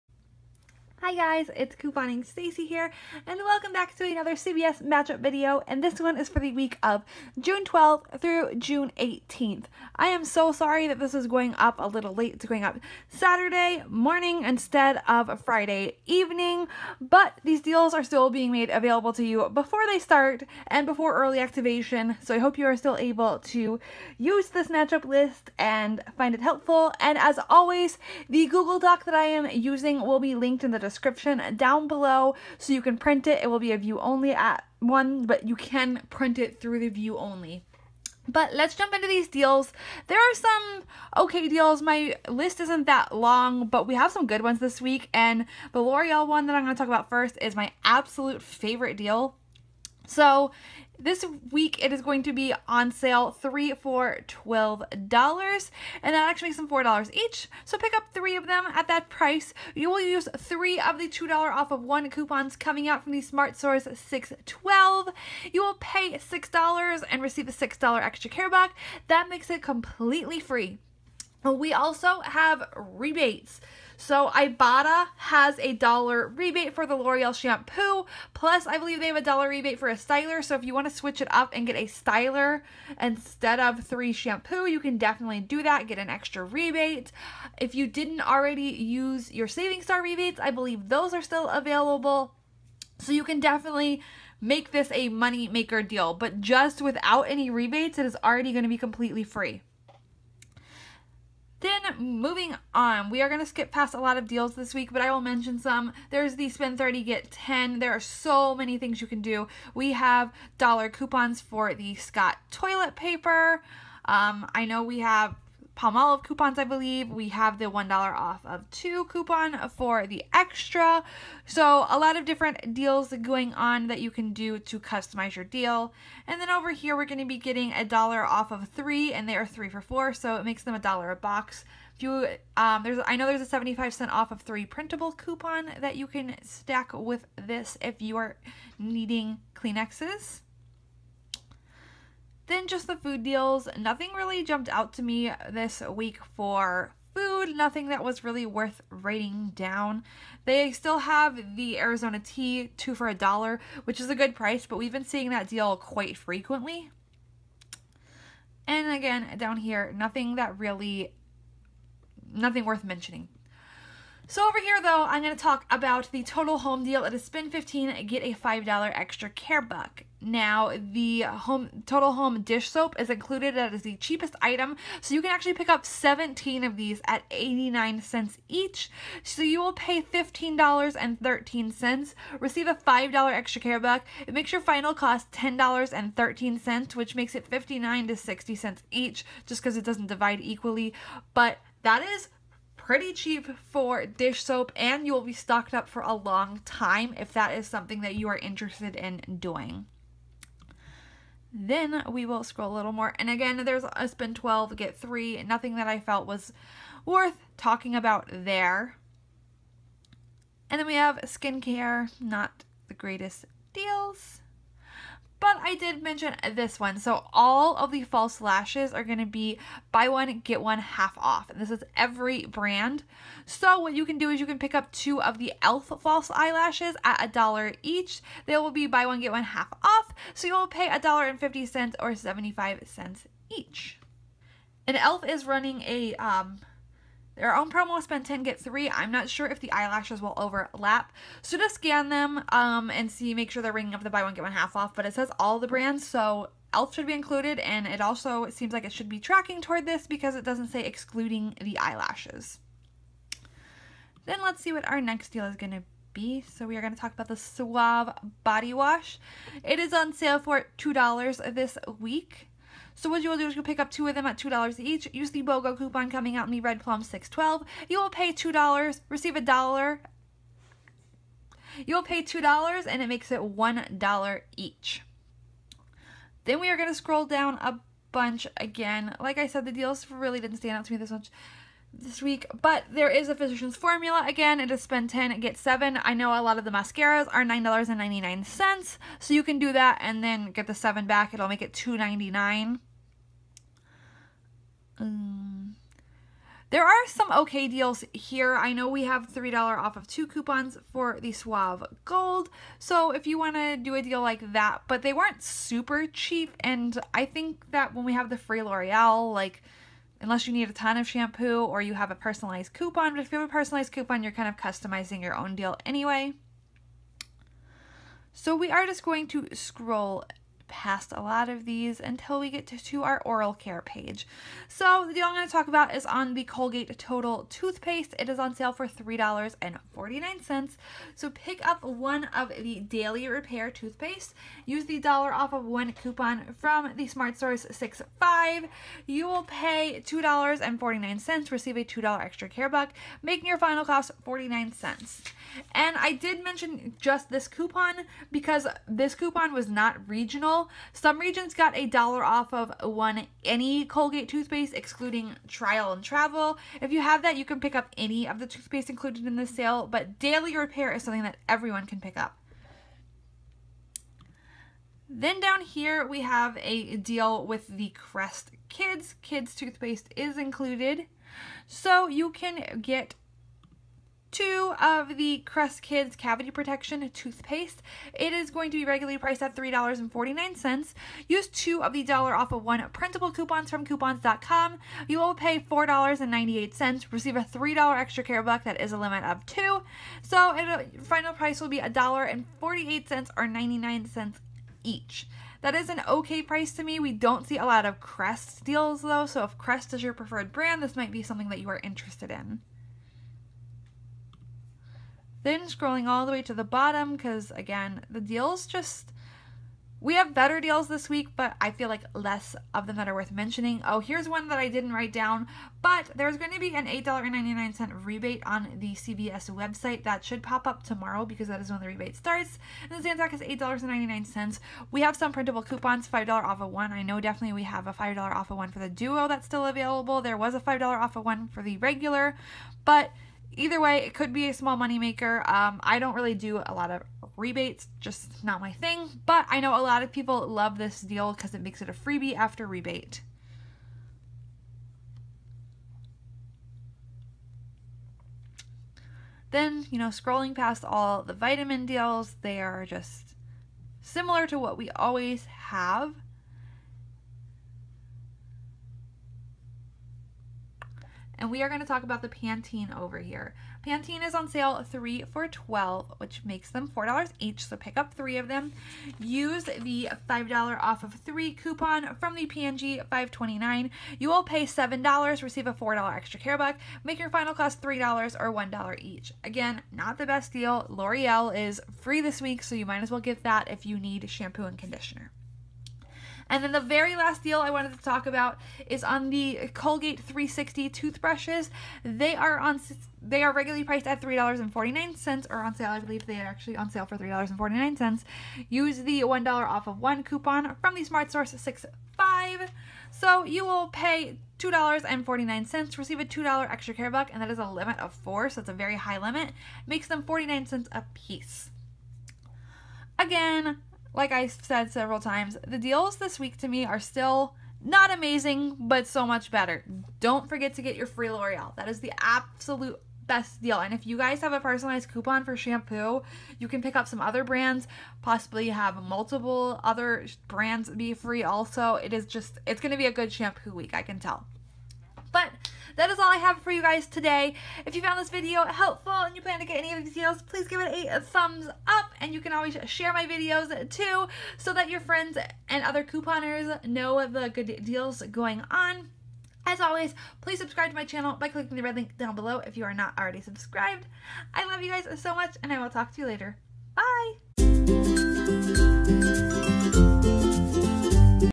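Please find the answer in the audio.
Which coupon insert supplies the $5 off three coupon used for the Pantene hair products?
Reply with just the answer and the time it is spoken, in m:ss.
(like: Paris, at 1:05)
P&G 529, at 7:52.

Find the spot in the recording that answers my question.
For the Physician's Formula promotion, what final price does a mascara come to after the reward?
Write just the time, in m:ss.
4:51.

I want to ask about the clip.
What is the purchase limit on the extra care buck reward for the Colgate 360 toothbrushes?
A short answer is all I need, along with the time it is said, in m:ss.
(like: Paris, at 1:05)
4, at 8:27.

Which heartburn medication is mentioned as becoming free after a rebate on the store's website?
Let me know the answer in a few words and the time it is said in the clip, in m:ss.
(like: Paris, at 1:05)
Zantac, at 7:03.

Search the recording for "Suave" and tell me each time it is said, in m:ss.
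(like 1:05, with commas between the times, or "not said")
4:17, 5:01.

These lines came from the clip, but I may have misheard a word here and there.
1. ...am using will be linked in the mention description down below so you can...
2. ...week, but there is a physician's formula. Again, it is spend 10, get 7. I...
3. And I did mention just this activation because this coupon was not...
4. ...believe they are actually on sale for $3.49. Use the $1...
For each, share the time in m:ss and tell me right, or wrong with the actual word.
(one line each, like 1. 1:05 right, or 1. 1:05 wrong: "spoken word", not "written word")
1. 0:29 wrong: "description", not "mention"
2. 4:42 right
3. 5:45 wrong: "coupon", not "activation"
4. 8:15 right.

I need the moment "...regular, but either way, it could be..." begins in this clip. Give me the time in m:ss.
7:11.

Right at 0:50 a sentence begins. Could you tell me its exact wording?
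So this week it is going to be on sale 3 for $12 and that actually makes them $4 each.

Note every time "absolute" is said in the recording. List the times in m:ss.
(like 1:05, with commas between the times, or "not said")
0:47, 8:42.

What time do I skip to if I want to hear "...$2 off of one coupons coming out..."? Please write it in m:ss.
1:01.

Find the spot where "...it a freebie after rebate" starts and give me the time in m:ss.
7:21.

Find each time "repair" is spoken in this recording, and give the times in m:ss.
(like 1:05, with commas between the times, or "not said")
5:33, 6:00.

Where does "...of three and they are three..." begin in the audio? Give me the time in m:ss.
2:08.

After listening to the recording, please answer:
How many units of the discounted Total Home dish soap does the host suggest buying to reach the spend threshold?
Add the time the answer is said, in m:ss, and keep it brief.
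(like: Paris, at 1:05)
17, at 2:55.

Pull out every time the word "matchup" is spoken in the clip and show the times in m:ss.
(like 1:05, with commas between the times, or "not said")
0:04, 0:24.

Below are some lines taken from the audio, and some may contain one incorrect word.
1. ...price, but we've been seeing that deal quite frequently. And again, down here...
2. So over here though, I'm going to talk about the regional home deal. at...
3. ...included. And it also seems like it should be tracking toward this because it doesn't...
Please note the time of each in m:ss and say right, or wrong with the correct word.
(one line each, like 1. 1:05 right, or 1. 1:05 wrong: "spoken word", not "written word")
1. 2:34 right
2. 2:44 wrong: "total", not "regional"
3. 4:07 right.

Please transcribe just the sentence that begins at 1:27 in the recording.
If you didn't already use your Saving Star rebates, I believe those are still available.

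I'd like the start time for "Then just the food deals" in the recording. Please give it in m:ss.
2:22.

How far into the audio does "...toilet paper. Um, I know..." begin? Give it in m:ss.
1:52.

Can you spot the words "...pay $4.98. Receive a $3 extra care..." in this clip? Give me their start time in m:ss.
6:25.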